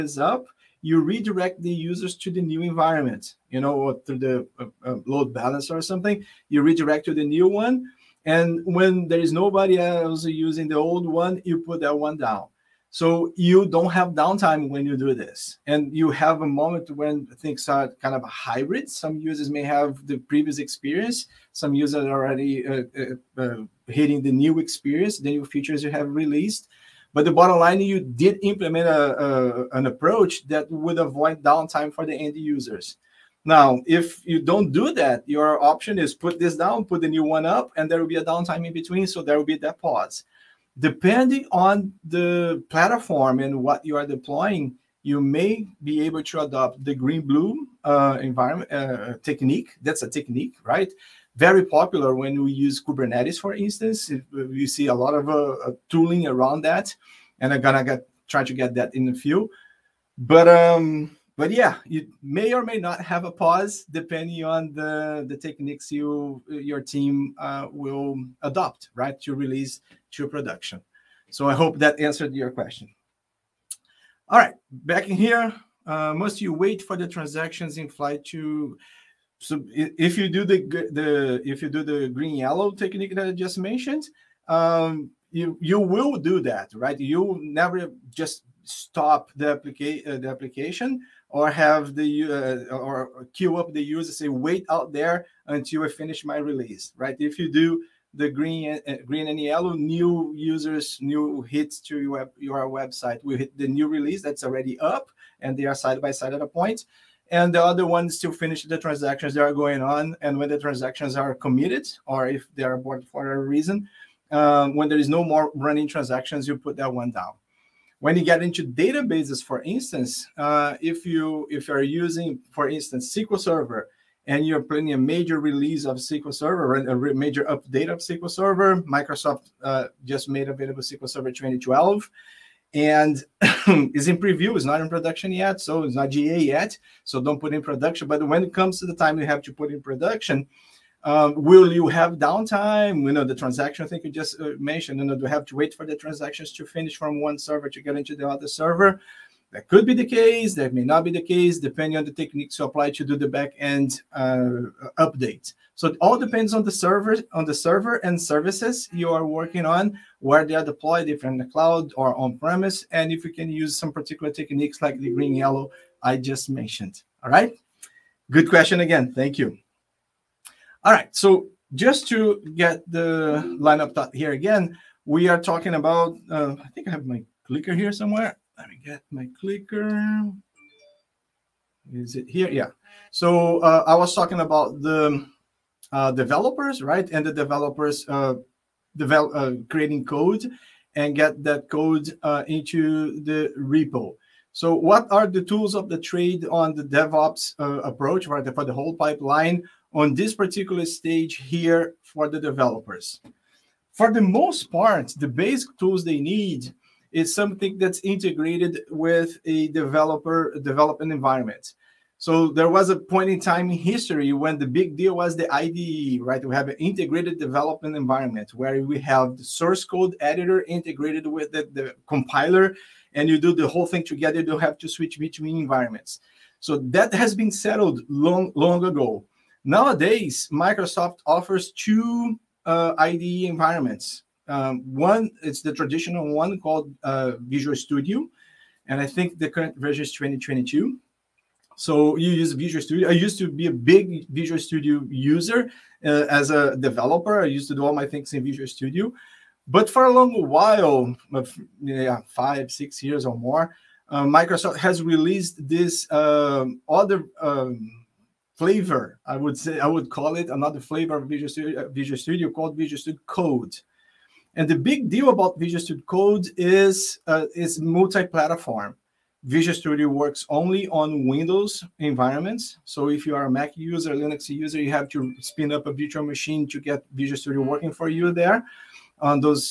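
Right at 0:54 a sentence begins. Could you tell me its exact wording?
You see a lot of uh, uh, tooling around that, and I'm gonna get, try to get that in a few.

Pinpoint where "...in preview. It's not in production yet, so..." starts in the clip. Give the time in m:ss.
2:14.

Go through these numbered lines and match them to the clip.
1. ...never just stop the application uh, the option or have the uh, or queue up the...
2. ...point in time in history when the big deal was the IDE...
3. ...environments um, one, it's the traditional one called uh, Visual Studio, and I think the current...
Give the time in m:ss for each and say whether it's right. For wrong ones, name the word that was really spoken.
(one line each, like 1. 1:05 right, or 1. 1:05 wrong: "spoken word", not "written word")
1. 1:27 wrong: "application", not "option"
2. 3:32 right
3. 3:53 right.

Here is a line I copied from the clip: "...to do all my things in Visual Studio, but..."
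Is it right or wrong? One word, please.
right.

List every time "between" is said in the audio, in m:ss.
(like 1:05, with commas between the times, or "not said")
0:38, 3:45.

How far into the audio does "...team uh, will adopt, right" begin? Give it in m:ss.
1:06.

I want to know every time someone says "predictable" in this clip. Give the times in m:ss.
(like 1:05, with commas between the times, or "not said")
not said.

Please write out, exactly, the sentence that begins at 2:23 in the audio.
You know the transaction thing you just uh, mentioned.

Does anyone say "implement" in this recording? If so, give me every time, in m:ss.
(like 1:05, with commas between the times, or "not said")
0:28.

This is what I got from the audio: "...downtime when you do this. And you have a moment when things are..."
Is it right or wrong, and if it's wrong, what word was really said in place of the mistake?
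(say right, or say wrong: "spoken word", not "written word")
right.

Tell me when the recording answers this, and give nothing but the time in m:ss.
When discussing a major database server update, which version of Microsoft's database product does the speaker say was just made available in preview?
2:10.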